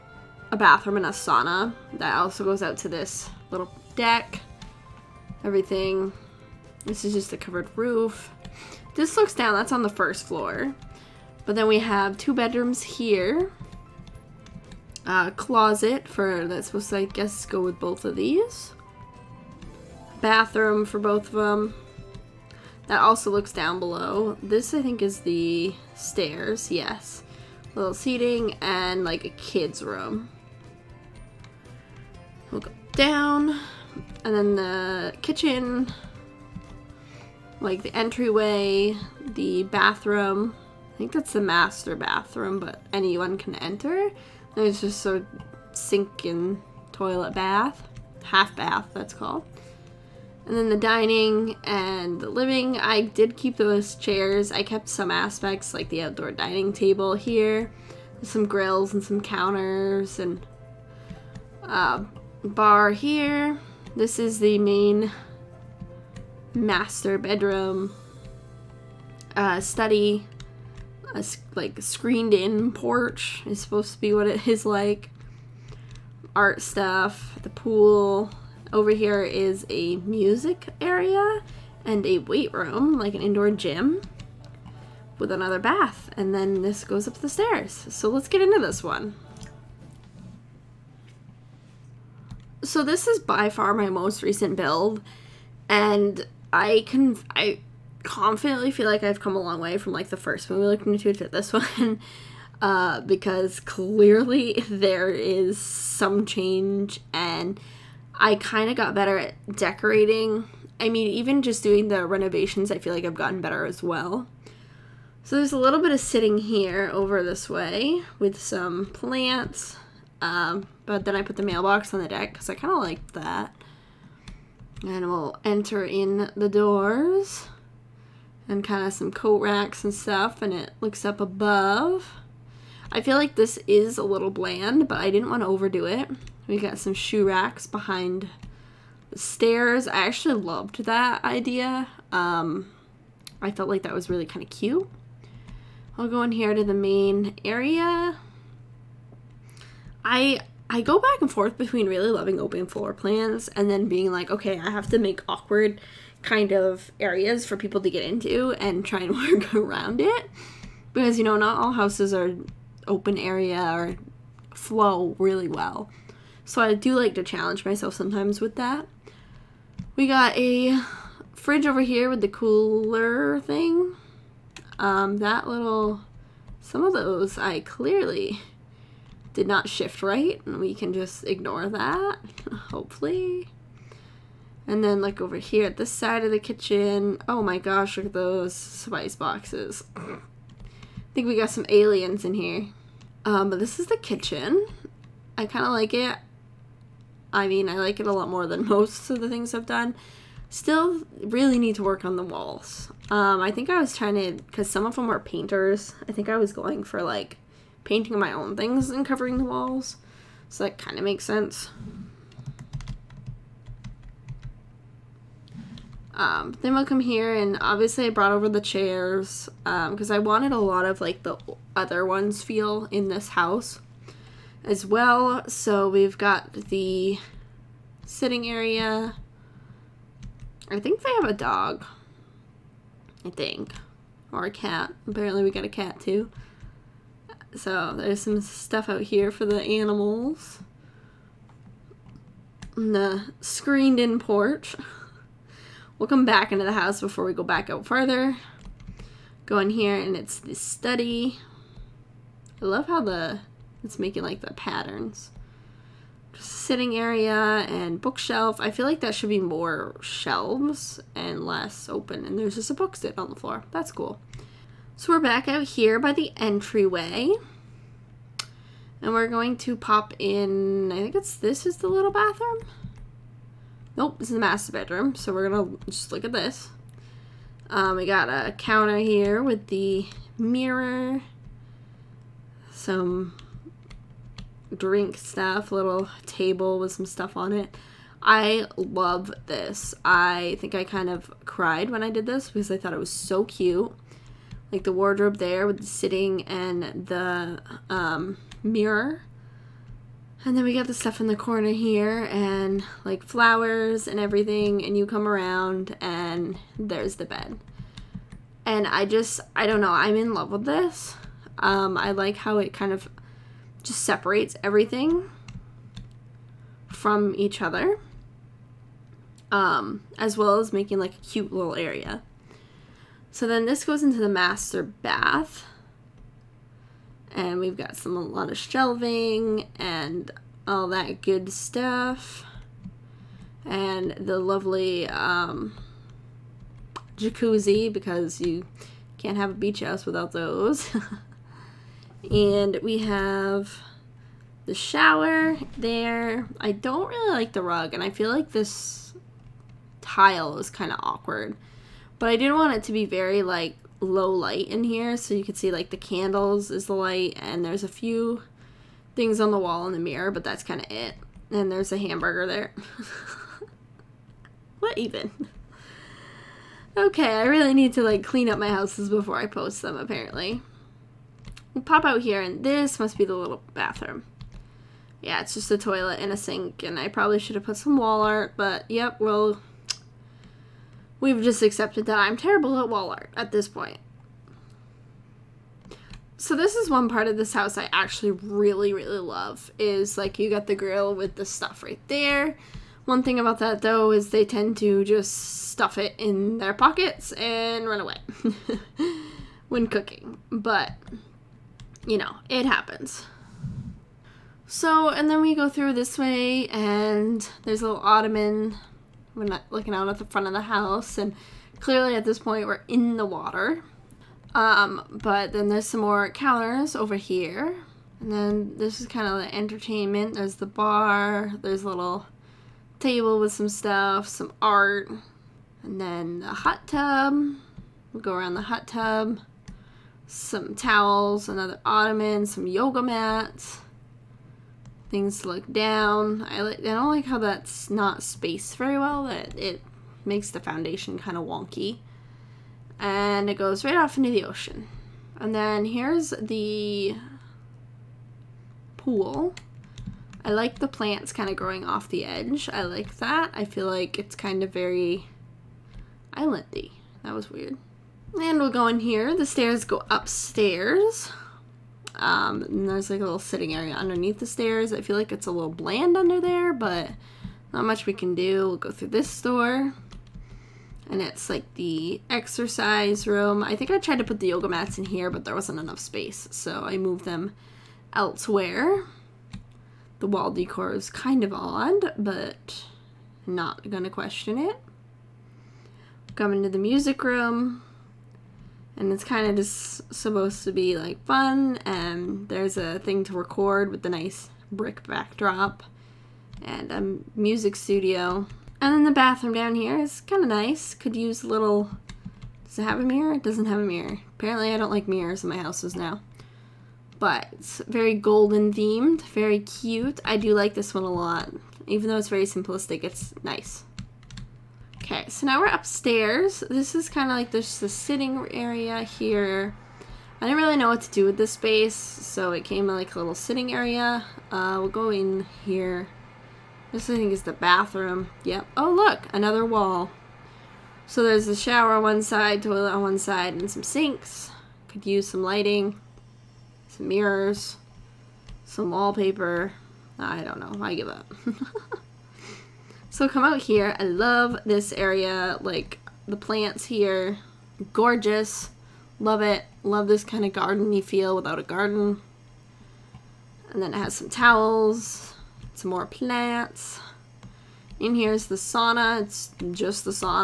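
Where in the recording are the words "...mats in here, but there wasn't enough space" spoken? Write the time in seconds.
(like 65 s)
474 s.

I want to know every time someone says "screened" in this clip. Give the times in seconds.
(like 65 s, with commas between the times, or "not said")
71 s, 243 s.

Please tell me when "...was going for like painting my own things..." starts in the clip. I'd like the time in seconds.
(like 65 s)
206 s.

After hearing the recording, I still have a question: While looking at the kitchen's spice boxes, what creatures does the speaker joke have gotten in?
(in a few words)
aliens.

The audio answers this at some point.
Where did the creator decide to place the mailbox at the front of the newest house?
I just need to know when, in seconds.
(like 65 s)
121 s.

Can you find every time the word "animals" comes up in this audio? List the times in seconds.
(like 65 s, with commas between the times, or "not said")
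239 s.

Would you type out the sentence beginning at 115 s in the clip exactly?
So there's a little bit of sitting here over this way with some plants.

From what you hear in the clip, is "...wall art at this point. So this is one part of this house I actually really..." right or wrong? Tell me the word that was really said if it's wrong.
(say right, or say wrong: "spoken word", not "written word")
right.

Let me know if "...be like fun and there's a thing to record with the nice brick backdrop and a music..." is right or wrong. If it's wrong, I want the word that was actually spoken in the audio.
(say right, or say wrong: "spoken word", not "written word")
right.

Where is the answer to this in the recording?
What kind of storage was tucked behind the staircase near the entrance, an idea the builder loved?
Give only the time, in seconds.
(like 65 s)
136 s.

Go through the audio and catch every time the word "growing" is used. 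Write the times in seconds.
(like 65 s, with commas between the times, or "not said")
451 s.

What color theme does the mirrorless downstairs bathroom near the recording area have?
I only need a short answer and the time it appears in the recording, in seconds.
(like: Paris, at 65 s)
golden, at 508 s.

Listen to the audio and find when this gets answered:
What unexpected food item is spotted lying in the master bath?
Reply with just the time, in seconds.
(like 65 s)
361 s.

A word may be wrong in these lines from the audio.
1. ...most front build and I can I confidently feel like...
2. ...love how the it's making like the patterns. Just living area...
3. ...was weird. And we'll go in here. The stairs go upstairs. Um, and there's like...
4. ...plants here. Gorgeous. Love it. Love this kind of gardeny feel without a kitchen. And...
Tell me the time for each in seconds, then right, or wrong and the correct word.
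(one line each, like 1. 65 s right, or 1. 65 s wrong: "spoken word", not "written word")
1. 93 s wrong: "recent", not "front"
2. 252 s wrong: "sitting", not "living"
3. 457 s right
4. 546 s wrong: "garden", not "kitchen".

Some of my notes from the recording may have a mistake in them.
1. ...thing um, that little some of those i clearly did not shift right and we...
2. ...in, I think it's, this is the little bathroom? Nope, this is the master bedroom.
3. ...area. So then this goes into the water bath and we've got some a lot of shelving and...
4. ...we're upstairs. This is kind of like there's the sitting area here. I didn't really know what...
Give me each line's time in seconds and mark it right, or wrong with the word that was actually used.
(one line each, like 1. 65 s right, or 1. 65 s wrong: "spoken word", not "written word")
1. 173 s right
2. 270 s right
3. 321 s wrong: "master", not "water"
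4. 515 s right.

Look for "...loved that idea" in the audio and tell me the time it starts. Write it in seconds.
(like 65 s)
140 s.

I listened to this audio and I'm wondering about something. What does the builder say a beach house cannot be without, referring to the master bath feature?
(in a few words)
jacuzzi.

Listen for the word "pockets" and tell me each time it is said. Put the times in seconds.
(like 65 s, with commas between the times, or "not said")
396 s.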